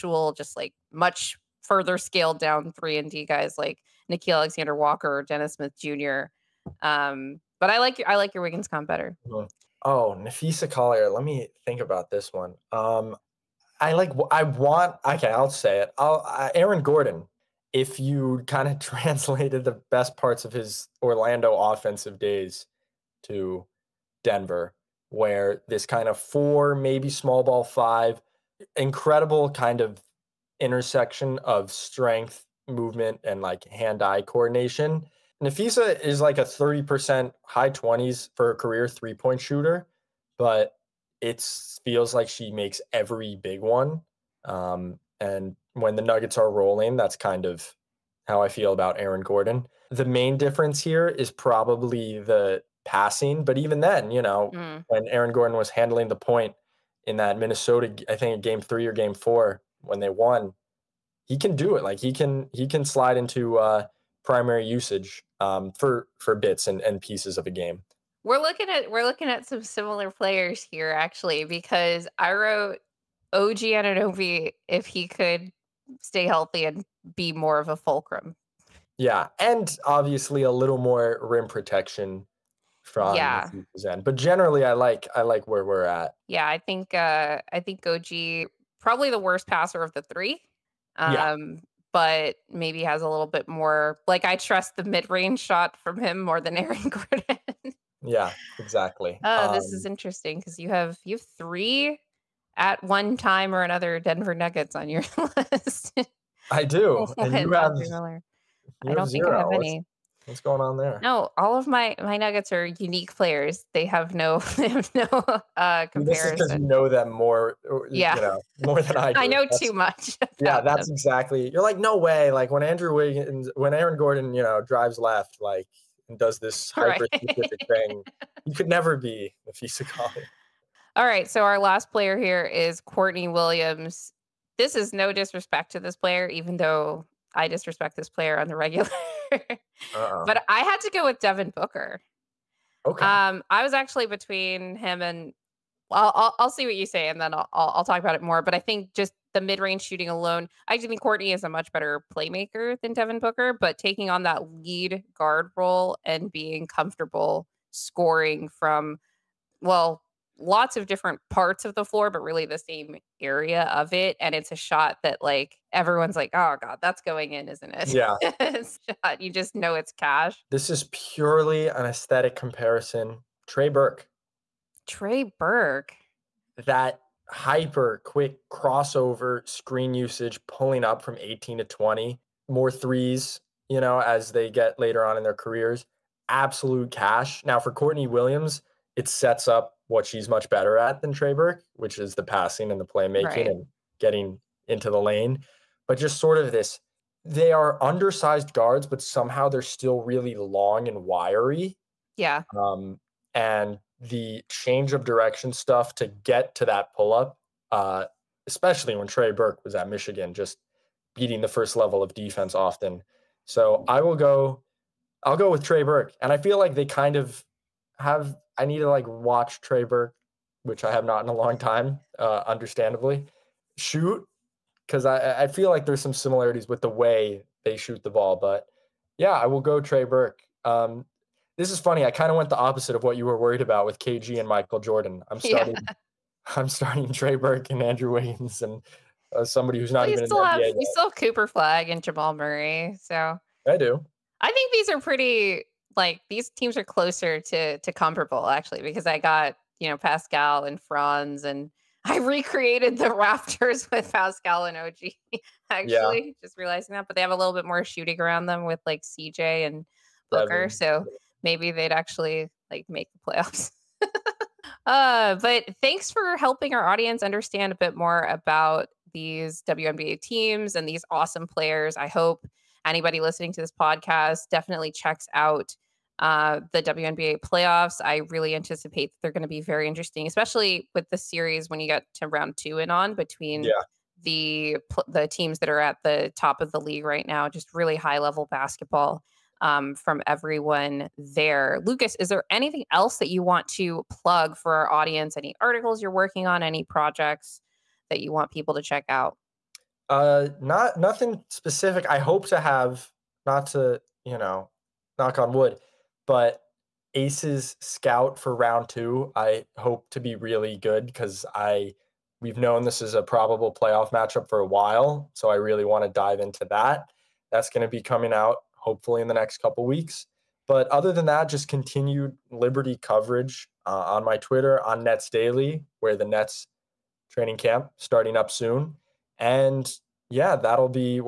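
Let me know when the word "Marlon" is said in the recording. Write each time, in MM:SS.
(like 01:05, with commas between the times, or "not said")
not said.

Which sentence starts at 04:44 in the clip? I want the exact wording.
the the teams that are at the top of the league right now.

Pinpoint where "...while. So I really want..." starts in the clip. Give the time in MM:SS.
05:14.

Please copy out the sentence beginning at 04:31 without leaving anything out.
I hope anybody listening to this podcast definitely checks out uh, the WNBA playoffs.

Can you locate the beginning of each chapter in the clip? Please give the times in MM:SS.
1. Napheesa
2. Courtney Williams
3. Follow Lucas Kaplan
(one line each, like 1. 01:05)
1. 00:09
2. 02:10
3. 04:59.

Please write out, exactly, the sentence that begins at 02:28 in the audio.
But I think just the mid range shooting alone, I think Courtney is a much better playmaker than Devin Booker.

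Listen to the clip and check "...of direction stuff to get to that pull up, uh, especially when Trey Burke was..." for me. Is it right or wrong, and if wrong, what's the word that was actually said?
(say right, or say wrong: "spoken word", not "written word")
right.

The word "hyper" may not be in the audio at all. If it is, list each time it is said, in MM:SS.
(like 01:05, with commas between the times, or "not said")
02:06, 02:57.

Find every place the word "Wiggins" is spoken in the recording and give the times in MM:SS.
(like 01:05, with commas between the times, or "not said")
00:08, 02:02, 03:58.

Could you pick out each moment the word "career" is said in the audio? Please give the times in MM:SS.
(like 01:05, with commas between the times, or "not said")
00:38, 03:05.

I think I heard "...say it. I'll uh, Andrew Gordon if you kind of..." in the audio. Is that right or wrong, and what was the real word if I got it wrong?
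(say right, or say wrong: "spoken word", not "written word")
wrong: "Aaron", not "Andrew".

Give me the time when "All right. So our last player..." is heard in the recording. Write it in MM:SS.
02:10.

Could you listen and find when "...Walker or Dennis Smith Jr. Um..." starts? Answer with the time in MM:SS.
00:04.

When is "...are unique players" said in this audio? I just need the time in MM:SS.
01:52.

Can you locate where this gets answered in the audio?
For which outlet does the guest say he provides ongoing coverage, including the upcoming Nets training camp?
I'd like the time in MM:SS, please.
05:25.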